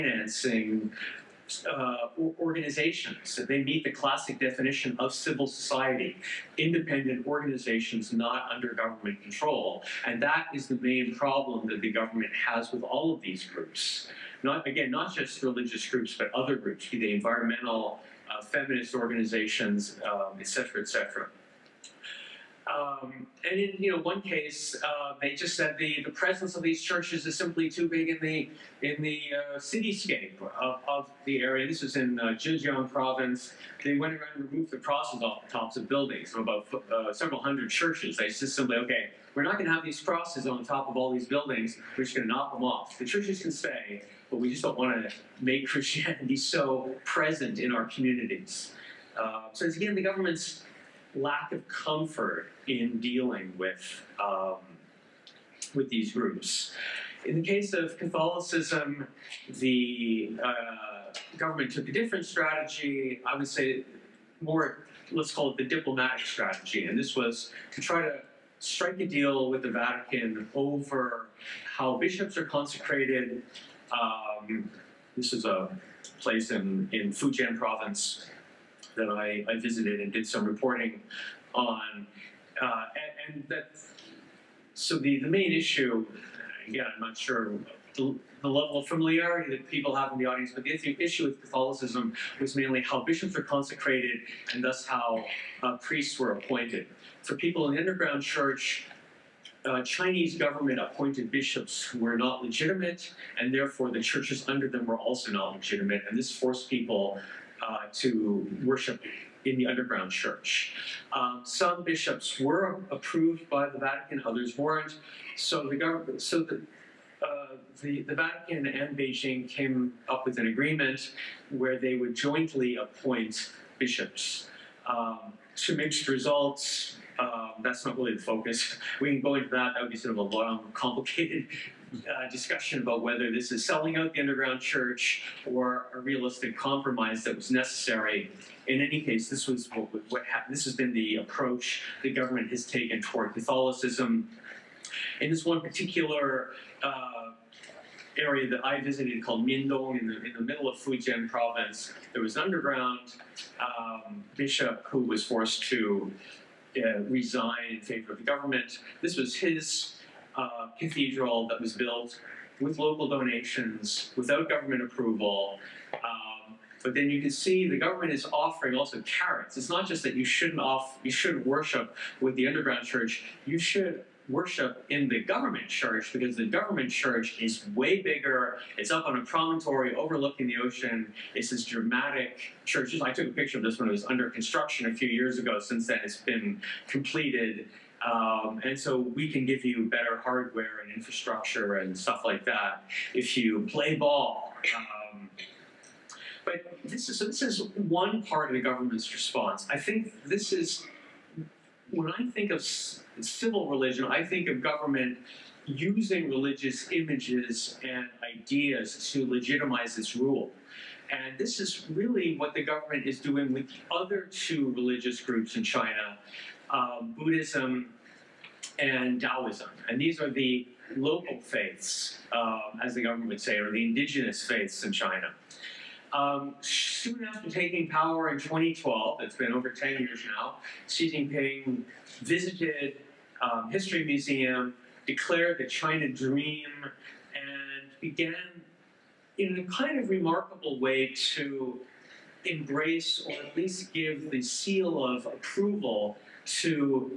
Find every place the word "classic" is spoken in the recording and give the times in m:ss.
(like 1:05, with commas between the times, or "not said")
0:03.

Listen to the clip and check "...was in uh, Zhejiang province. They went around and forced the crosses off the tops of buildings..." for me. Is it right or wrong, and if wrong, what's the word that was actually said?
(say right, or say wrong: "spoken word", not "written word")
wrong: "removed", not "forced".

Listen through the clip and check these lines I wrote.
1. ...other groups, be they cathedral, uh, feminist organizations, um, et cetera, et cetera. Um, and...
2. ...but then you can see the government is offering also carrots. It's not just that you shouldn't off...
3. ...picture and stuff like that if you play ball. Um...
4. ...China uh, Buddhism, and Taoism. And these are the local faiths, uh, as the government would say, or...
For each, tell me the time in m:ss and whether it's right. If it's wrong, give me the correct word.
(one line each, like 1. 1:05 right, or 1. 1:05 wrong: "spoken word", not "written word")
1. 0:16 wrong: "environmental", not "cathedral"
2. 2:46 right
3. 3:10 wrong: "infrastructure", not "picture"
4. 3:35 right.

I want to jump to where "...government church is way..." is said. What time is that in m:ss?
2:56.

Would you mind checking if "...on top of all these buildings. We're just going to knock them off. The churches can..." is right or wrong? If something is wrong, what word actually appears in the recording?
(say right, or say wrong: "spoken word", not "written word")
right.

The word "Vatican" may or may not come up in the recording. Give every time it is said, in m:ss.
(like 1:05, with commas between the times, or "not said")
1:09, 1:53, 1:58.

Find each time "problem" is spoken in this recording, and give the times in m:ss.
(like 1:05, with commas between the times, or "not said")
0:11.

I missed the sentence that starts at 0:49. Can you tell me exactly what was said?
Uh, so it's again the government's lack of comfort in dealing with, um, with these groups.